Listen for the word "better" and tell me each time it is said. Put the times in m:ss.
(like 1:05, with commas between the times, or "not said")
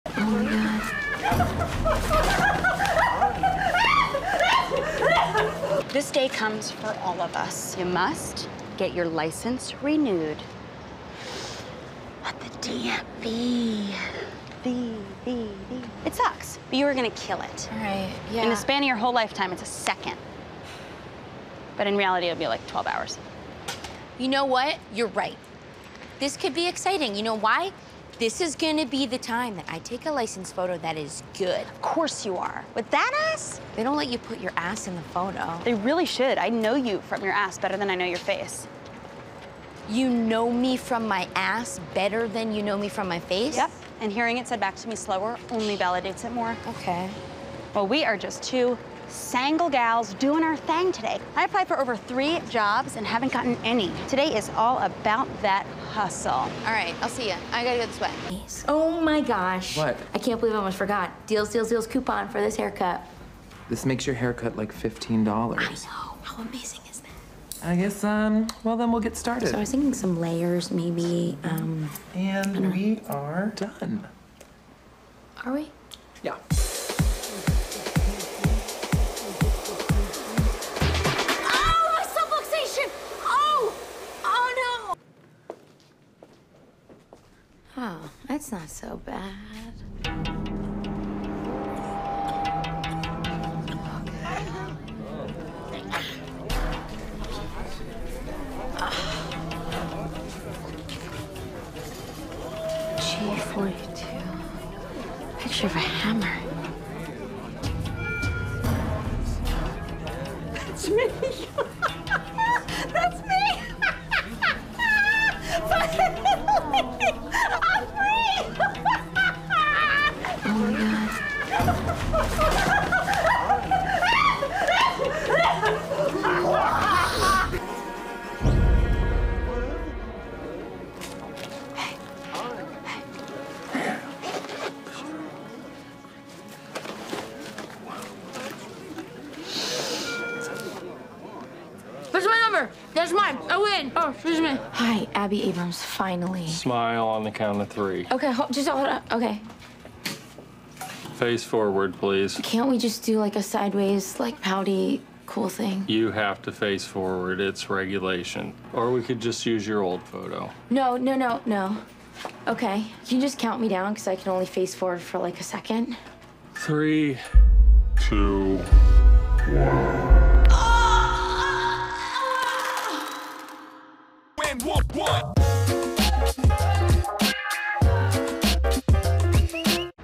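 0:37, 0:41.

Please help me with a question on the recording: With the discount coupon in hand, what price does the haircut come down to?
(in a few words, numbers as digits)
$15.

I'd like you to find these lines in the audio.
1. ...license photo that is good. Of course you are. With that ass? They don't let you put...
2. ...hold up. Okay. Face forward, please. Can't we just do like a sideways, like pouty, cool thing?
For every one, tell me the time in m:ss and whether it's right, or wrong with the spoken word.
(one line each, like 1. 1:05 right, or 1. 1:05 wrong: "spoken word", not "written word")
1. 0:30 right
2. 2:28 right.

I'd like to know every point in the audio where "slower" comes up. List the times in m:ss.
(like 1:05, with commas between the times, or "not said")
0:44.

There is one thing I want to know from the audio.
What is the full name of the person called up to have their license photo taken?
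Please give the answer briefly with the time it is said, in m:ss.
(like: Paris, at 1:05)
Abbi Abrams, at 2:25.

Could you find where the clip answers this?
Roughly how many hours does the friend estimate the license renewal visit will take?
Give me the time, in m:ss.
0:22.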